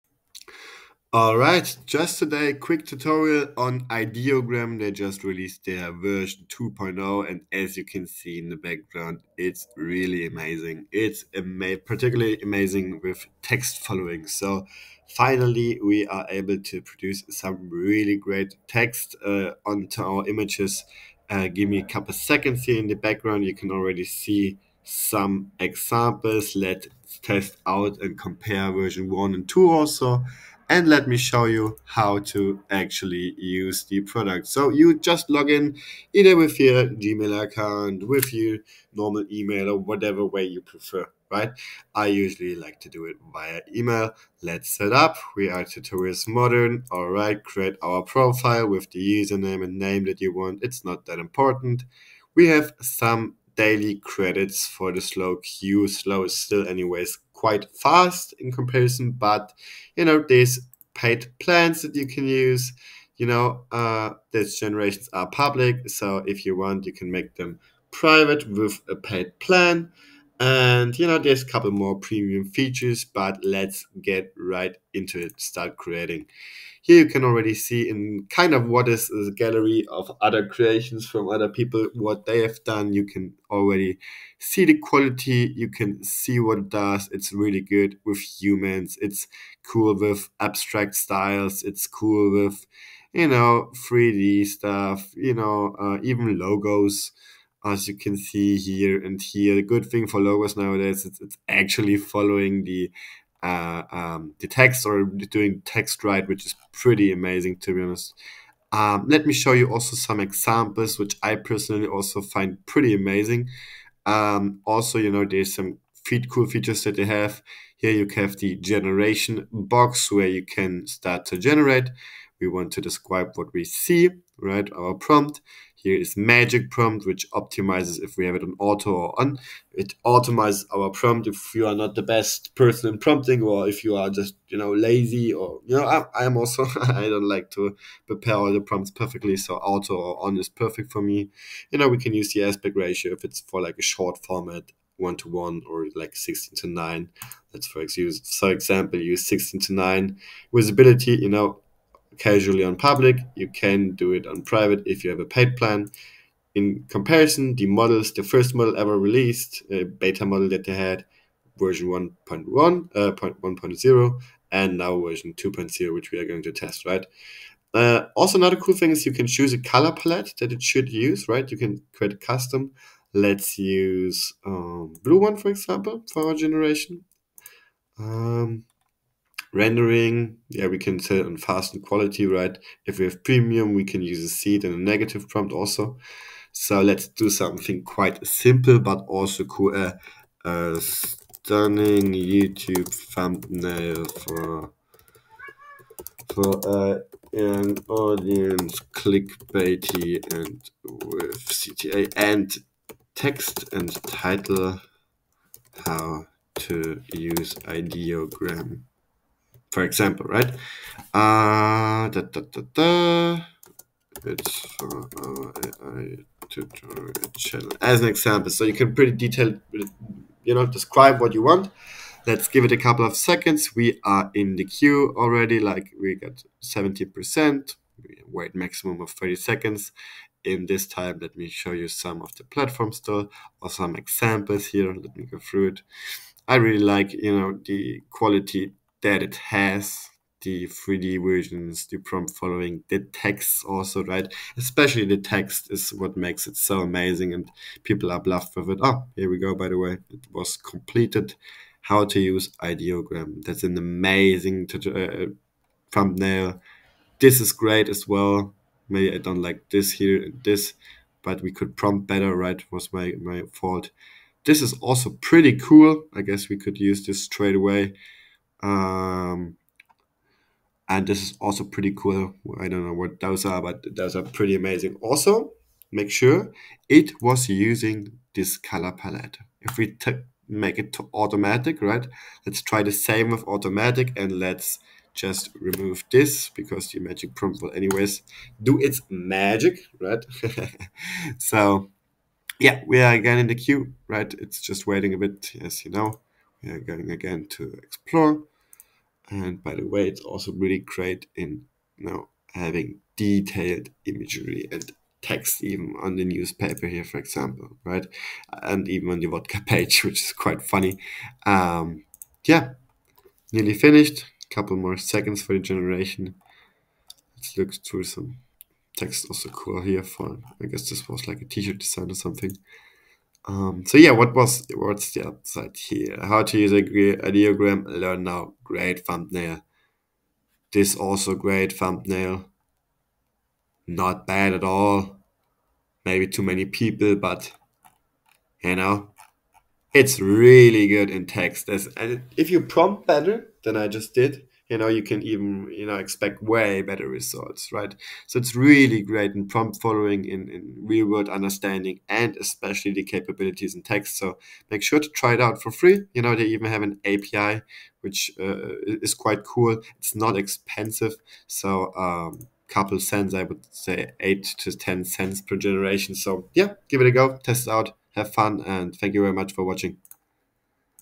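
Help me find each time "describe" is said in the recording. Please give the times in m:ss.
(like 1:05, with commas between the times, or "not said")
2:02, 3:40.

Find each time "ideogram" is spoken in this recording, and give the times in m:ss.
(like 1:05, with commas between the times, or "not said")
0:03, 3:27, 4:12, 5:26.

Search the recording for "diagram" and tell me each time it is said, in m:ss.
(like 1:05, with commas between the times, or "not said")
5:27.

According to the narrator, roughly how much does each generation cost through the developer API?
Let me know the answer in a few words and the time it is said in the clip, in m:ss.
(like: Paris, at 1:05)
8 to 10 cents, at 6:04.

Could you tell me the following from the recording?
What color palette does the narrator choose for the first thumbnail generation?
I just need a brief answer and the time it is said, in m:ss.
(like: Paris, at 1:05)
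blue, at 2:55.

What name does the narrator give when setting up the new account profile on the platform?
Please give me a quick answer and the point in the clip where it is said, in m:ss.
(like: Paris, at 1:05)
Tutorials Modern, at 0:45.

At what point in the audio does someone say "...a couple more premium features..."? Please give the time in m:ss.
1:11.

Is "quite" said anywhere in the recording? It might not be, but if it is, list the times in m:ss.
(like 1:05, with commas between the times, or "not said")
0:57, 3:07, 5:10, 5:59.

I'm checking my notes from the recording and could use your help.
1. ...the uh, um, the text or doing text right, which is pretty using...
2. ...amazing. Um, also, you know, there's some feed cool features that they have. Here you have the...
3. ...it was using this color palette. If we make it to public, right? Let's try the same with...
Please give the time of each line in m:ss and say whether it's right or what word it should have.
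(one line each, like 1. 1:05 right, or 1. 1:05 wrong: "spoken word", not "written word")
1. 1:42 wrong: "amazing", not "using"
2. 1:52 right
3. 4:36 wrong: "automatic", not "public".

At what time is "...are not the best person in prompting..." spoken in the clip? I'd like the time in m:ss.
2:11.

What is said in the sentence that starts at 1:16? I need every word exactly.
Here you can already see in kind of what is the gallery of other creations from other people, what they have done.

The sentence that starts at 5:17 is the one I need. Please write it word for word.
Let's look through some text also cool here for, I guess this was like a t-shirt design or something.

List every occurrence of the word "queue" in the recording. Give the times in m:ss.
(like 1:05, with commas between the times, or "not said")
0:55, 3:44, 4:53.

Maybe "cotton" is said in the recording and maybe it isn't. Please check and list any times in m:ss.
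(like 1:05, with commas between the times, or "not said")
not said.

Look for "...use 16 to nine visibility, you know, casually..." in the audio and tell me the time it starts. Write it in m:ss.
2:28.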